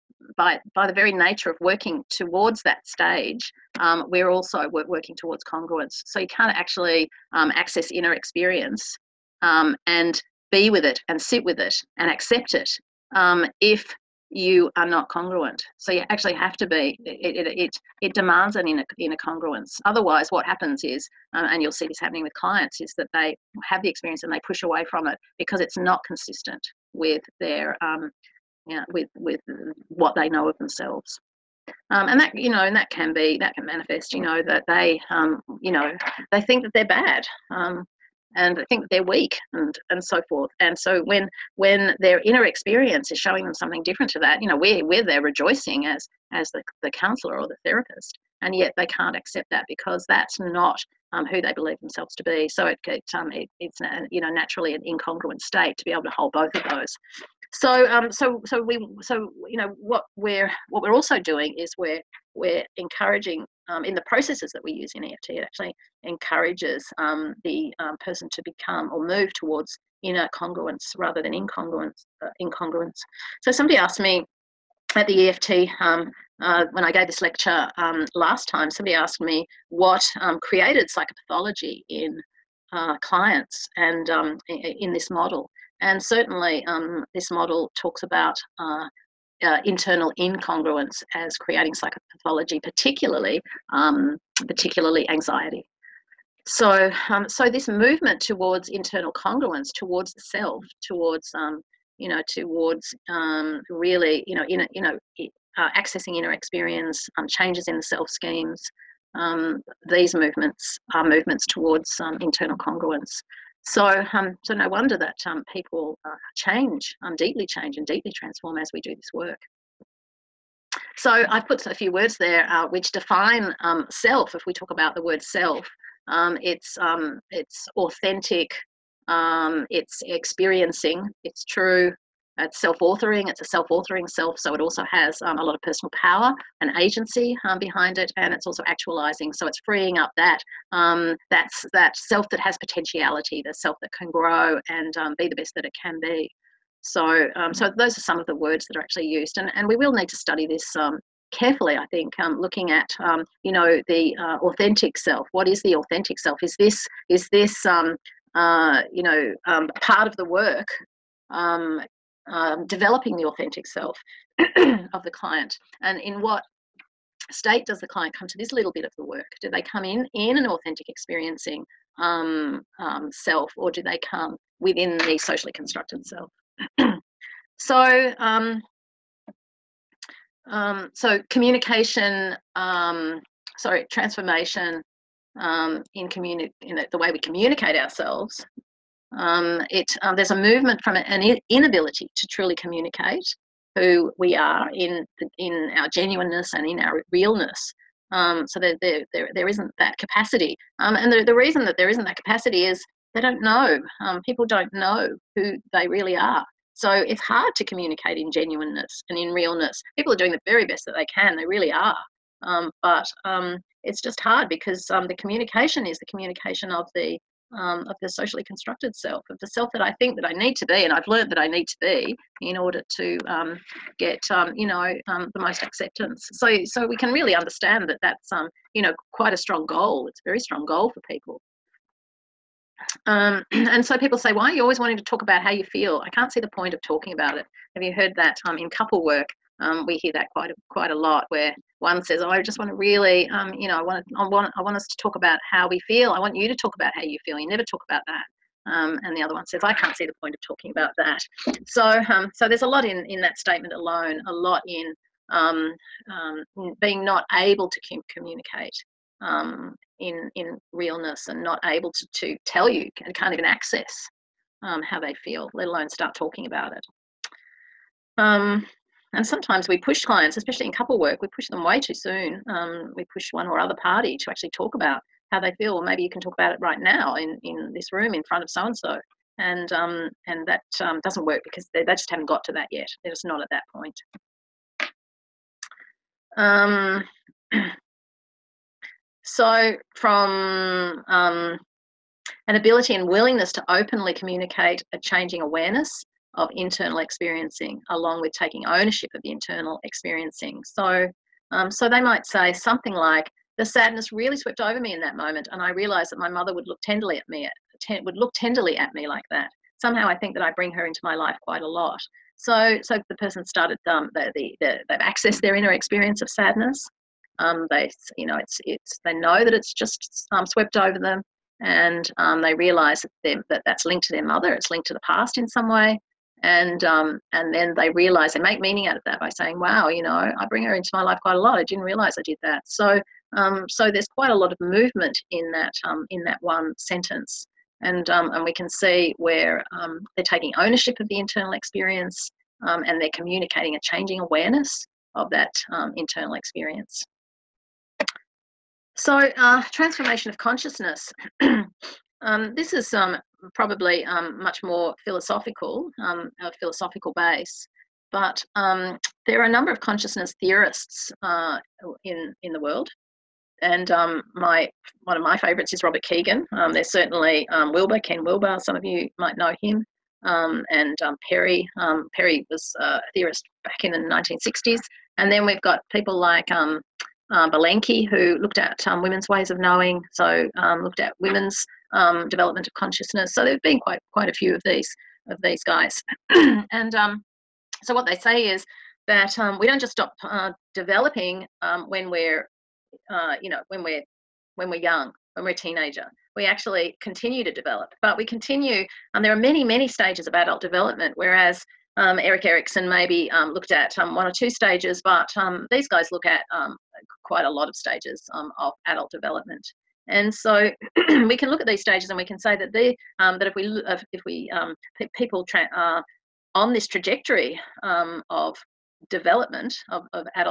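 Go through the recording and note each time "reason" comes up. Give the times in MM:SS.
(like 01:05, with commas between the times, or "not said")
03:21.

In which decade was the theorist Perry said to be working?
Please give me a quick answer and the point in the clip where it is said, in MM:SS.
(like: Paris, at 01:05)
1960s, at 06:13.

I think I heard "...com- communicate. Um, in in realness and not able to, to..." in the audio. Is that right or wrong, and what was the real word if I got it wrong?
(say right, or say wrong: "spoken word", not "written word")
right.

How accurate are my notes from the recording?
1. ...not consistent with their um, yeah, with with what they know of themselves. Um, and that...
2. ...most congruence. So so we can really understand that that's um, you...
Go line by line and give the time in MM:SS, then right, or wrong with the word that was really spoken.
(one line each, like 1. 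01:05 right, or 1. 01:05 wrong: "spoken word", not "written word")
1. 00:25 right
2. 03:45 wrong: "acceptance", not "congruence".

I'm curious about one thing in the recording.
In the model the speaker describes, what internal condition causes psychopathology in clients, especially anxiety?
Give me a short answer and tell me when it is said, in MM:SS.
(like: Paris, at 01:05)
internal incongruence, at 01:29.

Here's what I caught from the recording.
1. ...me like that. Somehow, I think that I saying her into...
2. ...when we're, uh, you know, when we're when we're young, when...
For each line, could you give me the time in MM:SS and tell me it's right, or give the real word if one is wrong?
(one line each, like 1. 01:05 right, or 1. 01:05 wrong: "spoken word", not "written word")
1. 05:08 wrong: "bring", not "saying"
2. 06:31 right.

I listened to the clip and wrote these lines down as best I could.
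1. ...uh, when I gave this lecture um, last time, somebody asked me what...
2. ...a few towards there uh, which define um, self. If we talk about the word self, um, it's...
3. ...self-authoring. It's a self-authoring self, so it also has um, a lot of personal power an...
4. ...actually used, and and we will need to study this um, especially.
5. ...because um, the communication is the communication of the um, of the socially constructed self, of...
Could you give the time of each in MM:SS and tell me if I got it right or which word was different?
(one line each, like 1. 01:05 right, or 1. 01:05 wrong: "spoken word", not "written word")
1. 01:16 right
2. 02:01 wrong: "words", not "towards"
3. 02:12 right
4. 02:28 wrong: "carefully", not "especially"
5. 03:34 right.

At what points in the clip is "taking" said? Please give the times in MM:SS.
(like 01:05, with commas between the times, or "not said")
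04:58, 05:40.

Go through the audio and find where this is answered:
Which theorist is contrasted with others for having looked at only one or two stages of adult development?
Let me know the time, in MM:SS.
06:42.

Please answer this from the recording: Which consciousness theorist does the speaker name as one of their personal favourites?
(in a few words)
Robert Kegan.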